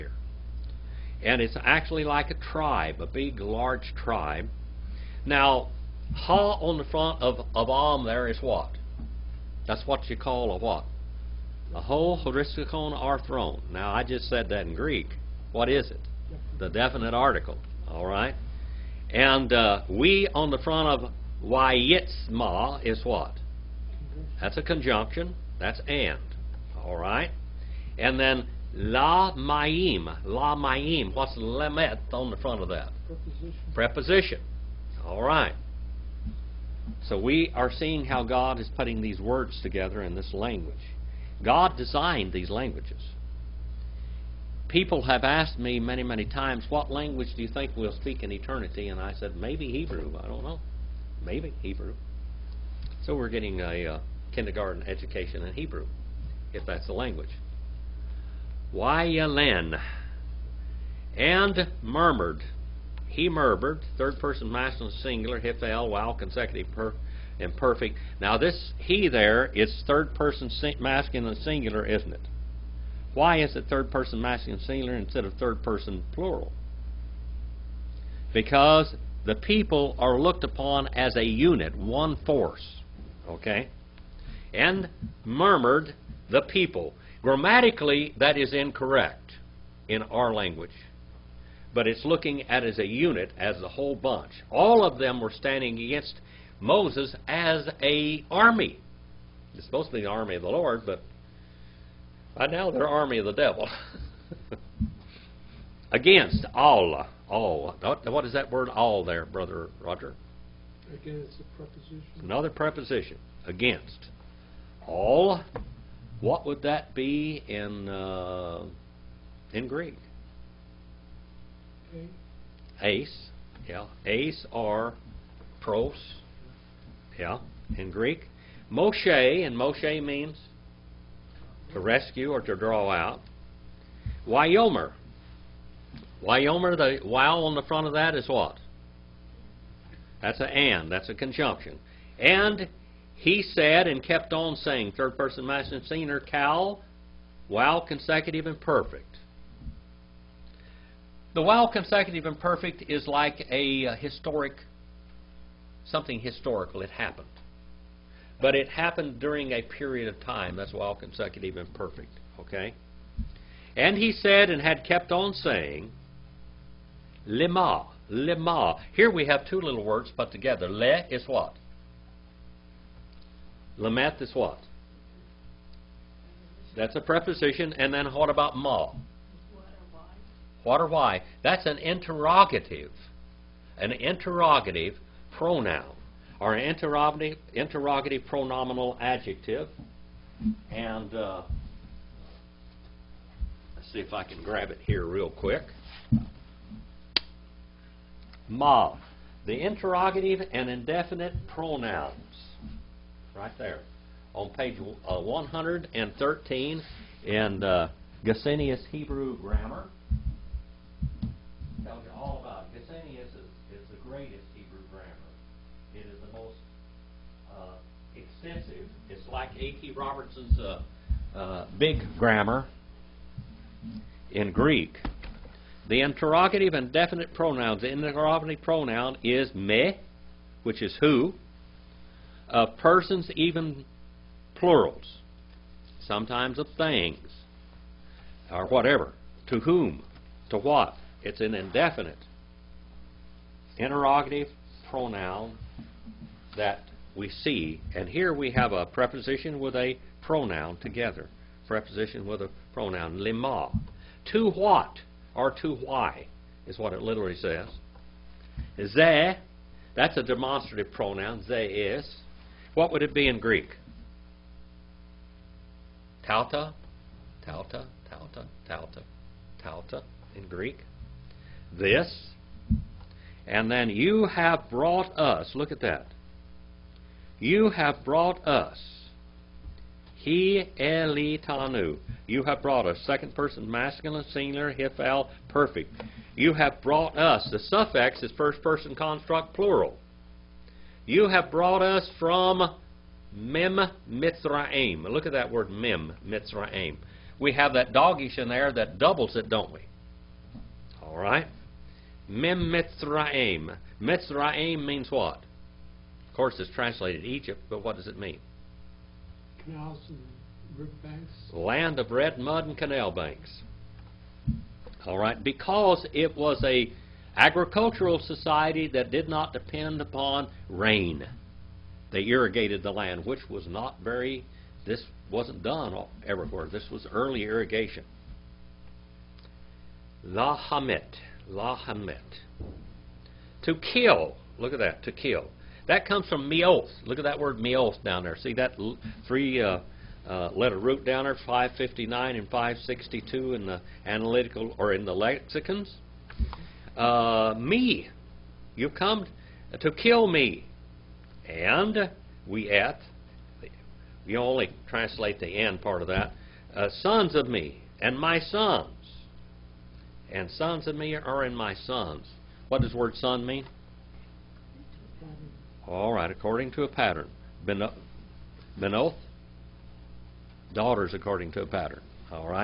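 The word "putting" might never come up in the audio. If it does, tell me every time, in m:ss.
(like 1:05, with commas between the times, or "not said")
0:38.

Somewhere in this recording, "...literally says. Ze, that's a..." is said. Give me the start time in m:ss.
4:17.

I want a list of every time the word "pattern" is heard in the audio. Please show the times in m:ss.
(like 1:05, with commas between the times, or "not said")
6:06, 6:11.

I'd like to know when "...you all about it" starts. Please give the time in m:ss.
3:32.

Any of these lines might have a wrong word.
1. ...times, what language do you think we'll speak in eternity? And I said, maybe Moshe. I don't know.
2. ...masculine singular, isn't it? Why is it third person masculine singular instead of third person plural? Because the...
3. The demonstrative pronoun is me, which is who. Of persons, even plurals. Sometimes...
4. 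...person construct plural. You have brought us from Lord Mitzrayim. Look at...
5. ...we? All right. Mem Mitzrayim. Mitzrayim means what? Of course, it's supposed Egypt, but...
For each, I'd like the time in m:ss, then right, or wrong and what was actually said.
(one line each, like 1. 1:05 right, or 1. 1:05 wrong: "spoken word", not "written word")
1. 0:46 wrong: "Hebrew", not "Moshe"
2. 1:10 right
3. 3:47 wrong: "interrogative", not "demonstrative"
4. 4:48 wrong: "Mem", not "Lord"
5. 4:59 wrong: "translated", not "supposed".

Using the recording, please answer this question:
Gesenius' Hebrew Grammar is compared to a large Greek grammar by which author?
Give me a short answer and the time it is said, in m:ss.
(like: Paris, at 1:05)
A.T. Robertson, at 3:39.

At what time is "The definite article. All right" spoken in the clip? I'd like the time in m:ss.
0:16.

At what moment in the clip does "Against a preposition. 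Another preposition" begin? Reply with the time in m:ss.
1:50.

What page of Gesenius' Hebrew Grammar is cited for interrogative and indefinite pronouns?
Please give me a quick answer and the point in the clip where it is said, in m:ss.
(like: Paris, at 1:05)
113, at 3:25.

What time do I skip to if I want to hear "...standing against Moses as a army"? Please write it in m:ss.
1:35.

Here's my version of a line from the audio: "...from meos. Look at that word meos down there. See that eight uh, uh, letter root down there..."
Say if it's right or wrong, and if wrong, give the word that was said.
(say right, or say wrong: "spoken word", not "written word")
wrong: "three", not "eight".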